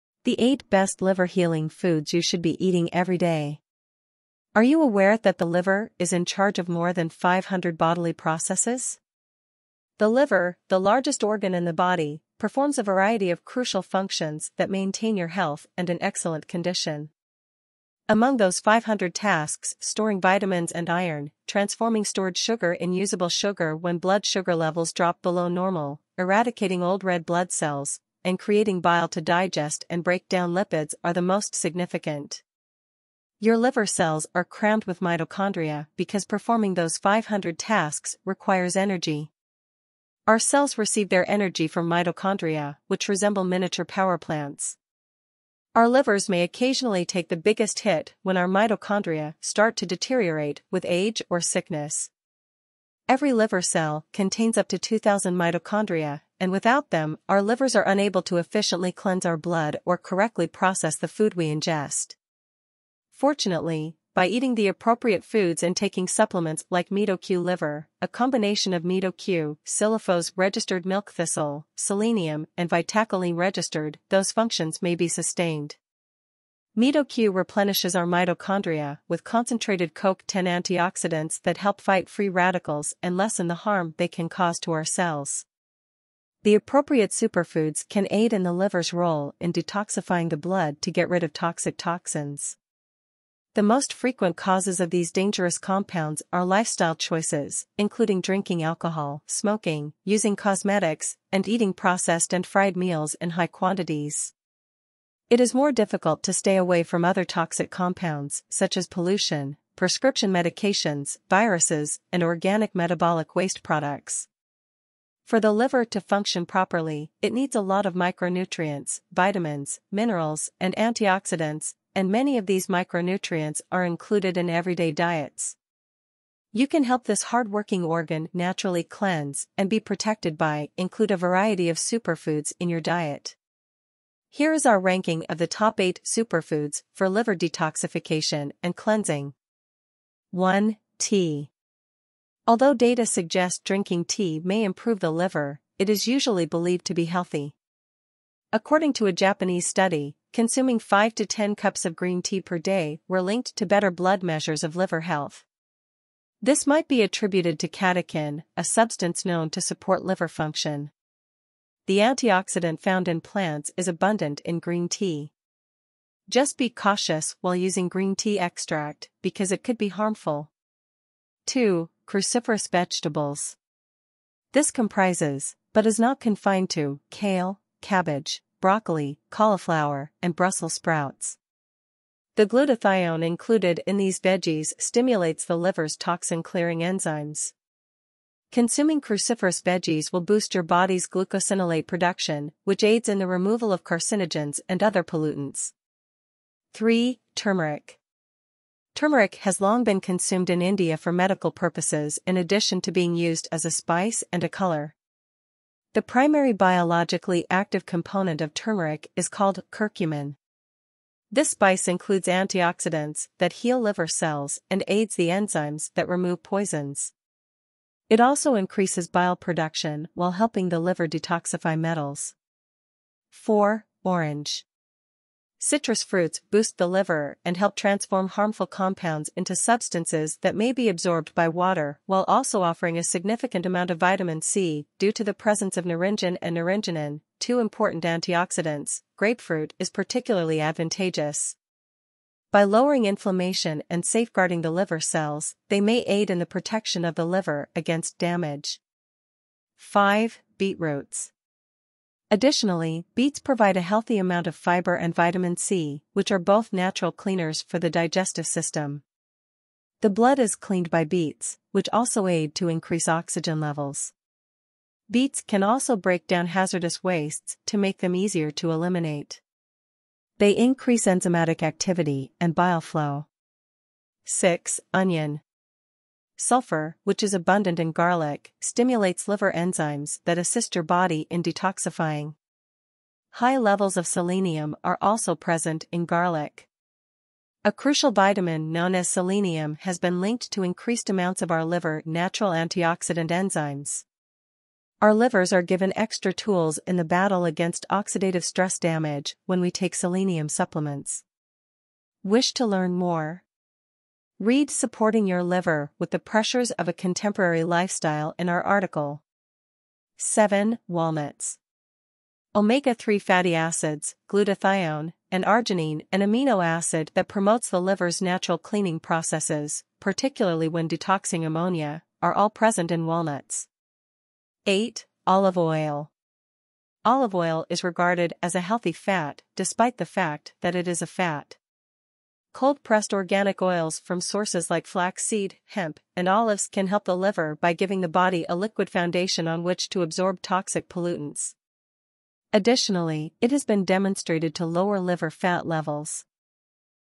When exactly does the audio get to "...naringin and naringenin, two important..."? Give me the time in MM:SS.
03:55.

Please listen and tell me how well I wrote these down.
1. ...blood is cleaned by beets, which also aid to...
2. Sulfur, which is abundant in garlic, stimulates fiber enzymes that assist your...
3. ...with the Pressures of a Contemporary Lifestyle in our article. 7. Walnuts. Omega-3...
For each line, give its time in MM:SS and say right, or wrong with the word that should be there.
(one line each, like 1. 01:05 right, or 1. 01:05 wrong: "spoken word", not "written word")
1. 04:20 right
2. 04:36 wrong: "liver", not "fiber"
3. 05:05 right.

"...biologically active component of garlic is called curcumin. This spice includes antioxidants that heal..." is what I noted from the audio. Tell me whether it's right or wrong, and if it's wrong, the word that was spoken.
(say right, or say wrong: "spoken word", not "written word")
wrong: "turmeric", not "garlic".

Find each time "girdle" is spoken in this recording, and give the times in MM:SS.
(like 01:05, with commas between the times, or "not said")
not said.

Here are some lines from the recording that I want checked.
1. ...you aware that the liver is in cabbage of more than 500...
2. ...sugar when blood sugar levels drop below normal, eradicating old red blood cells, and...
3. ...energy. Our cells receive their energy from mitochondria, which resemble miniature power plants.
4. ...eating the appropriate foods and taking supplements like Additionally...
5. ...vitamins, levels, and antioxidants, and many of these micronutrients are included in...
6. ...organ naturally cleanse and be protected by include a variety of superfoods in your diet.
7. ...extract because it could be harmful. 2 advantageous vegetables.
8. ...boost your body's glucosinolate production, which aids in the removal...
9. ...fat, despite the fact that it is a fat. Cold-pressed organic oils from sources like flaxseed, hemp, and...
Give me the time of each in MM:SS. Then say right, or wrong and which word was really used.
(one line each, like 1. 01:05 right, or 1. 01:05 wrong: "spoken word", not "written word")
1. 00:04 wrong: "charge", not "cabbage"
2. 00:23 right
3. 00:38 right
4. 01:04 wrong: "MitoQ", not "Additionally"
5. 01:59 wrong: "minerals", not "levels"
6. 02:07 right
7. 02:48 wrong: "cruciferous", not "advantageous"
8. 03:10 right
9. 05:28 right.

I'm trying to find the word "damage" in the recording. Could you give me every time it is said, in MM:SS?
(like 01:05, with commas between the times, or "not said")
04:08, 04:58.